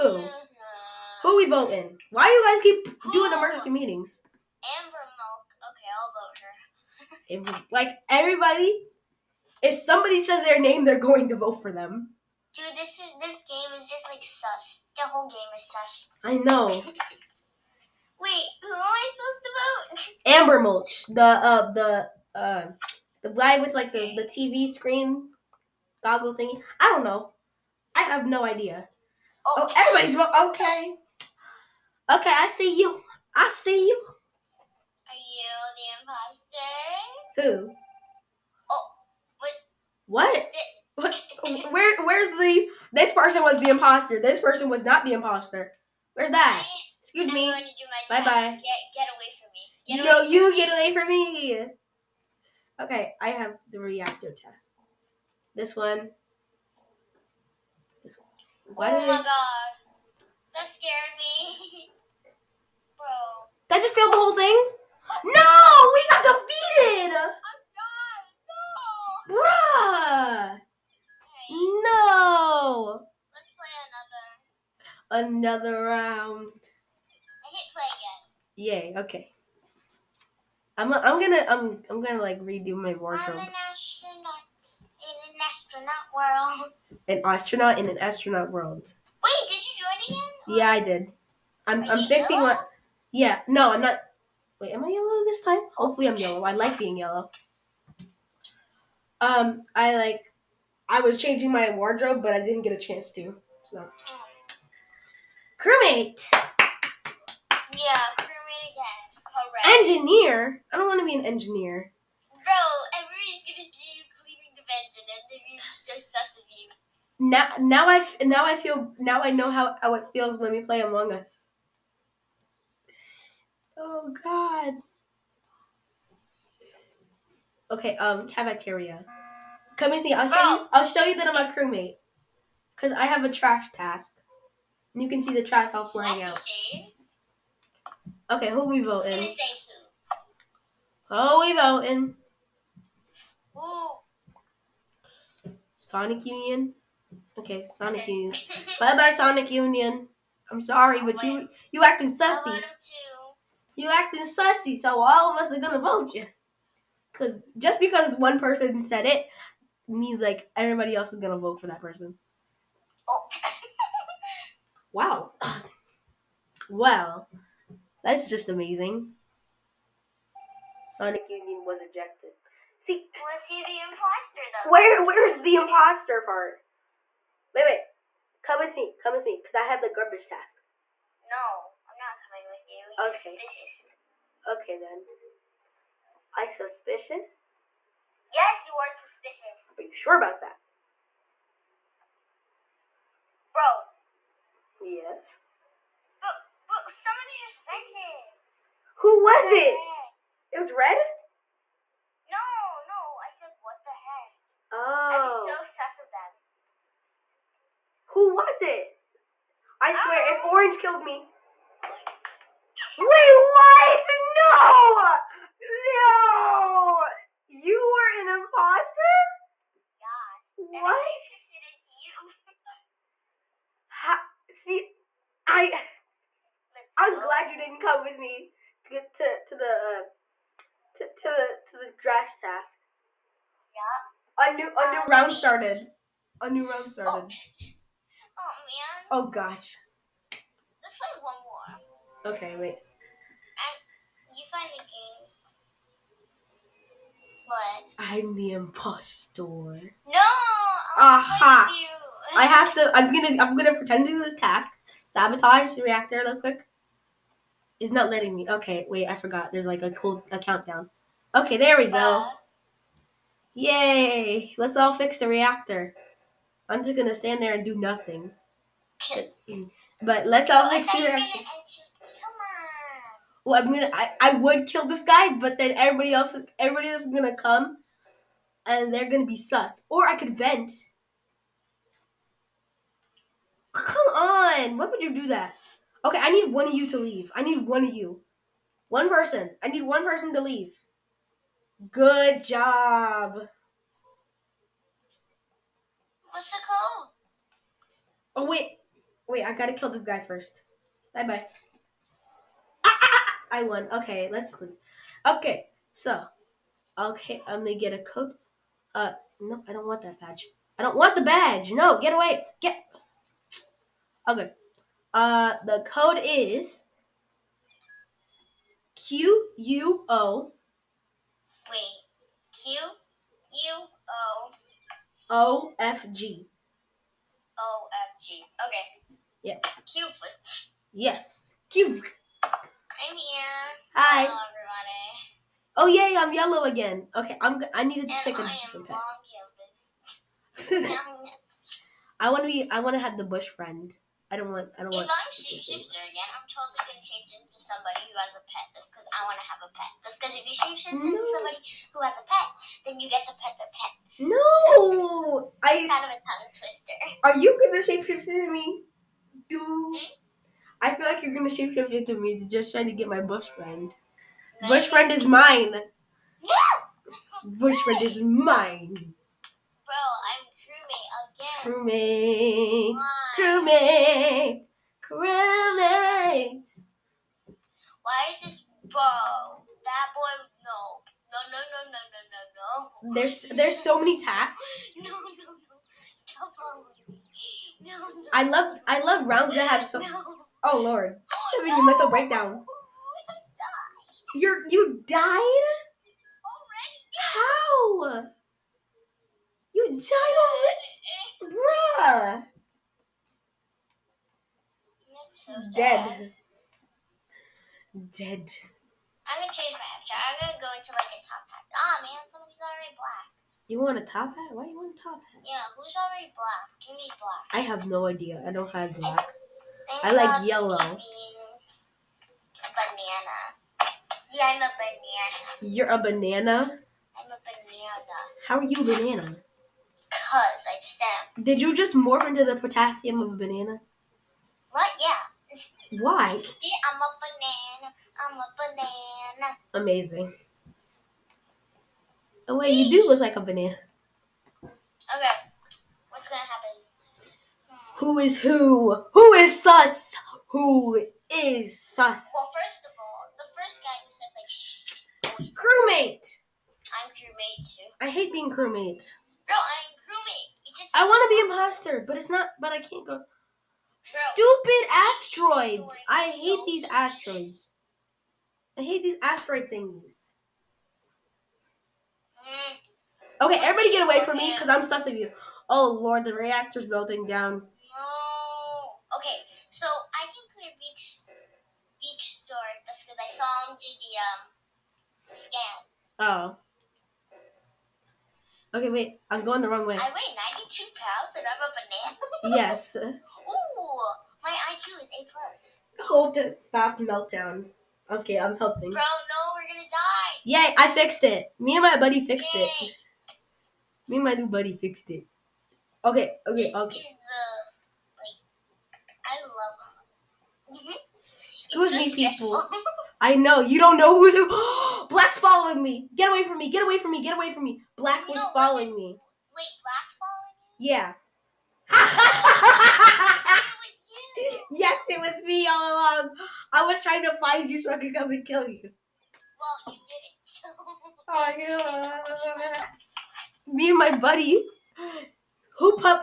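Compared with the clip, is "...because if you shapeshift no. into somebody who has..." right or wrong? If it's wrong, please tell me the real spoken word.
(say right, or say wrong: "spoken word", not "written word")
right.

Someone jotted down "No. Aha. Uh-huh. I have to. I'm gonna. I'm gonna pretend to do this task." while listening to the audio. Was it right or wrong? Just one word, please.
right.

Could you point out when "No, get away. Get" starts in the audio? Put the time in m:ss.
5:11.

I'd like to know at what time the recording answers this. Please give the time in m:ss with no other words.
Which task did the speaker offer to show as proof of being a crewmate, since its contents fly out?
2:12.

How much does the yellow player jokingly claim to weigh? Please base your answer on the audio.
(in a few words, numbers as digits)
92 pounds.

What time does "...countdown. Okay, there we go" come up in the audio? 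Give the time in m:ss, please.
4:20.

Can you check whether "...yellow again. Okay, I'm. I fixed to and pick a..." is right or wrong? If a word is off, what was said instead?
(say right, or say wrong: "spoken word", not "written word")
wrong: "needed", not "fixed".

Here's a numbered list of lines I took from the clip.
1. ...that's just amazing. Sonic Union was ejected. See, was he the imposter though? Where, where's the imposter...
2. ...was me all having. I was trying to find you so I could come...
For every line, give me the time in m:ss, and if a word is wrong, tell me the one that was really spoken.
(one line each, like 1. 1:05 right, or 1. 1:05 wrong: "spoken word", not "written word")
1. 2:48 right
2. 8:45 wrong: "along", not "having".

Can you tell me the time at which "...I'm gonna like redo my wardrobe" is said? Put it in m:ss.
1:21.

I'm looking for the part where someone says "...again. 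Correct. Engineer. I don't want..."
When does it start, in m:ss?
1:48.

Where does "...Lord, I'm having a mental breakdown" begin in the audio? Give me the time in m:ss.
6:30.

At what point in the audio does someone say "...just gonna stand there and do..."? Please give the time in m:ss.
4:26.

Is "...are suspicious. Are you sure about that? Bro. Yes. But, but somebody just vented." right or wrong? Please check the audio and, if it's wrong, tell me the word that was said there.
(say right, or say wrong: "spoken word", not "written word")
right.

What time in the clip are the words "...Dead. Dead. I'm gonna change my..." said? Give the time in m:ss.
6:45.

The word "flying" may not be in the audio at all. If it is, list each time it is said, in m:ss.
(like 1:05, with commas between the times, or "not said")
2:15.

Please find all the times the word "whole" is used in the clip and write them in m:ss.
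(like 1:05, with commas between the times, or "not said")
0:15, 1:04.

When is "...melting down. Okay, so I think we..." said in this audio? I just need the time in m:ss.
7:56.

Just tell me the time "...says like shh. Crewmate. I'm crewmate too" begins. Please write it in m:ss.
7:35.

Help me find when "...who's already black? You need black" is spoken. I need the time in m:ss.
6:55.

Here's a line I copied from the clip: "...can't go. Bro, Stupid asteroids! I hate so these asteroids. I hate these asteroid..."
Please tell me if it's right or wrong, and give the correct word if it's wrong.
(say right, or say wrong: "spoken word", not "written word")
right.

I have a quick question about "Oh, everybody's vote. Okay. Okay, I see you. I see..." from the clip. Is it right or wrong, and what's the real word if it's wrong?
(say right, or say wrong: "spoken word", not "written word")
right.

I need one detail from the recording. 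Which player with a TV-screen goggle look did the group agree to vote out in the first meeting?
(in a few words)
Amber Mulch.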